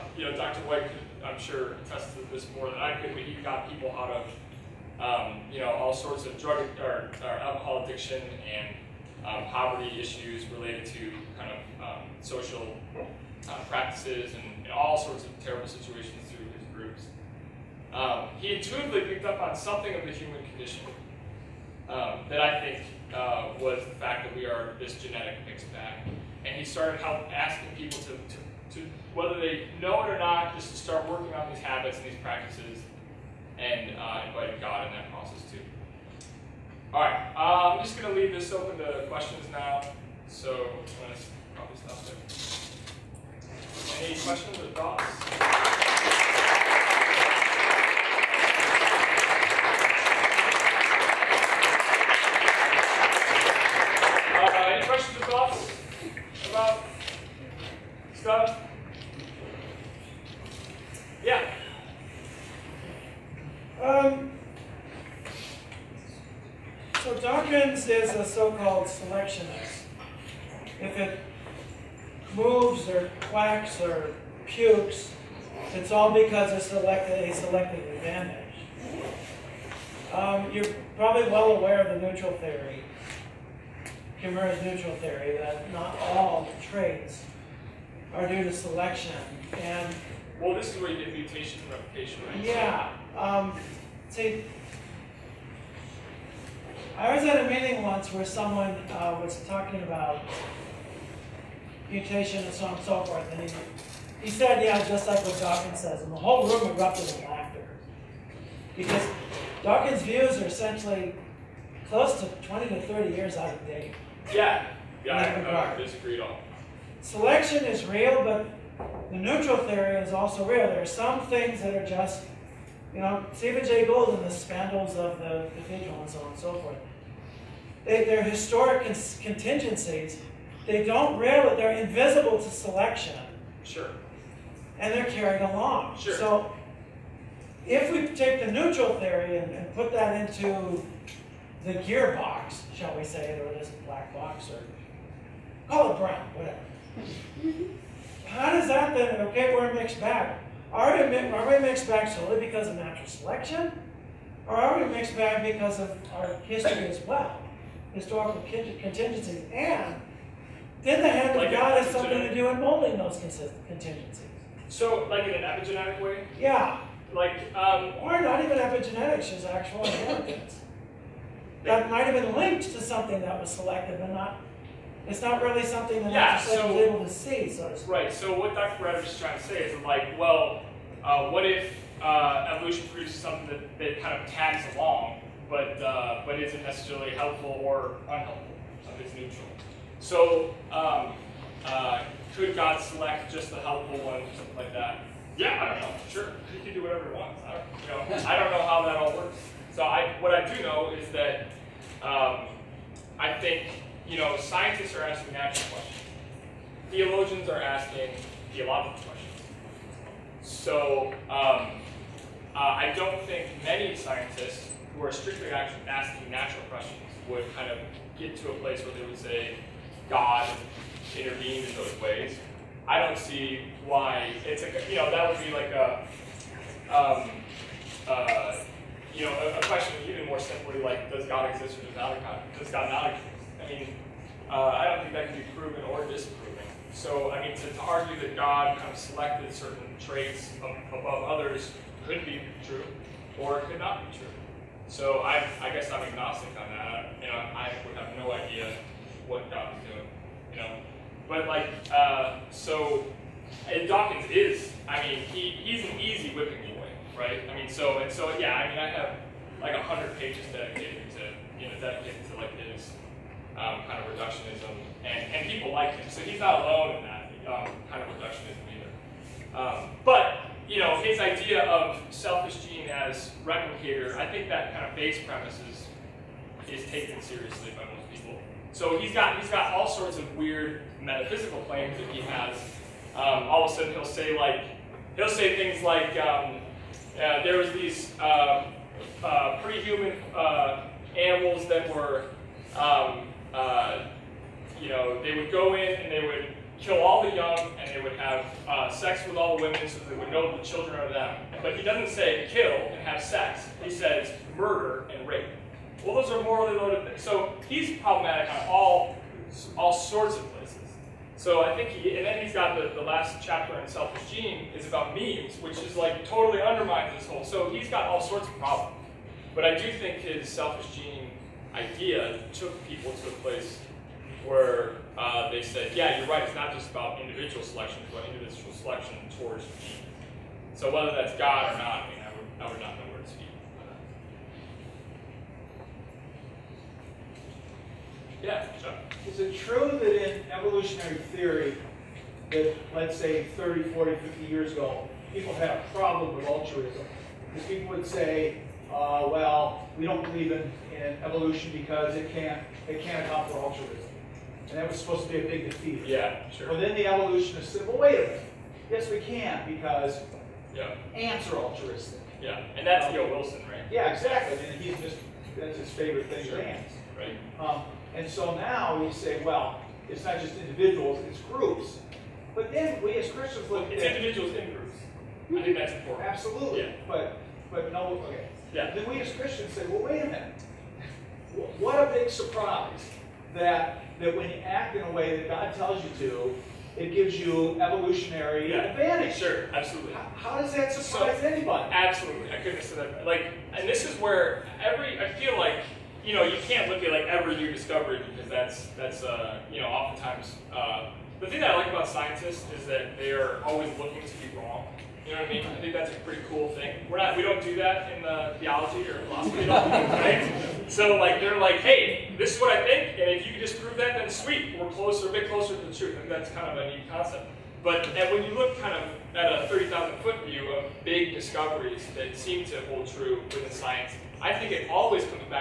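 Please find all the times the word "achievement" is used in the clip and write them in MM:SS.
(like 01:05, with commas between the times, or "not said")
not said.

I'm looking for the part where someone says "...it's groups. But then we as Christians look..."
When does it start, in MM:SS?
06:11.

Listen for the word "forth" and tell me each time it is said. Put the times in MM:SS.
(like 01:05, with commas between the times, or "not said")
01:43, 02:06.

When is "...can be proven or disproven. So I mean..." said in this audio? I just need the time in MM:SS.
03:55.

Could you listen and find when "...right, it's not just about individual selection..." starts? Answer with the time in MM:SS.
05:26.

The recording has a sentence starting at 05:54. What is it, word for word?
And that was supposed to be a big defeat.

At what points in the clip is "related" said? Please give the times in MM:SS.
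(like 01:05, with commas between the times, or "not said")
00:10.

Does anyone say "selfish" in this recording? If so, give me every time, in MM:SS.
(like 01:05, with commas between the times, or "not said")
04:32, 05:13, 05:20.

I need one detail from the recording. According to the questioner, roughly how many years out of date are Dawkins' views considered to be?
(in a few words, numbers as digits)
20 to 30 years.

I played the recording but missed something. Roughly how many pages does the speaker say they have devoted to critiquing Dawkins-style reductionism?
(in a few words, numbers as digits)
100.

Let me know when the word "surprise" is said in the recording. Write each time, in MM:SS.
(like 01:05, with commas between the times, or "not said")
06:22, 06:30.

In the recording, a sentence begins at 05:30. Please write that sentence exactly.
So whether that's God or not, I mean, I would, I would not know where to speak.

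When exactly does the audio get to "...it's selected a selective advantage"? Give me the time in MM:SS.
01:16.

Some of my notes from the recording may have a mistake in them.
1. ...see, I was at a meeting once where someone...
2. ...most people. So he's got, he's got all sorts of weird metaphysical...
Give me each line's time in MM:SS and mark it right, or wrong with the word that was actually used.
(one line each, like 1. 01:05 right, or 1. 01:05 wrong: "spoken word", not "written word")
1. 01:34 right
2. 04:37 right.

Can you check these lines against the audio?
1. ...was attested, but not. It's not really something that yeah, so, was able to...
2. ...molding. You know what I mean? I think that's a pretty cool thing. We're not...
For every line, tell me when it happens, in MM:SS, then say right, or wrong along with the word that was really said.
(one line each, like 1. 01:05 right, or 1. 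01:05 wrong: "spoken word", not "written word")
1. 02:53 wrong: "selected", not "attested"
2. 06:44 wrong: "wrong", not "molding".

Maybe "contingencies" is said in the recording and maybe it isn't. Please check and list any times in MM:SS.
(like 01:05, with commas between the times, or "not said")
02:09, 02:38, 02:43.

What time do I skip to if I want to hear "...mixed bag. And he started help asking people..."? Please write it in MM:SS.
00:25.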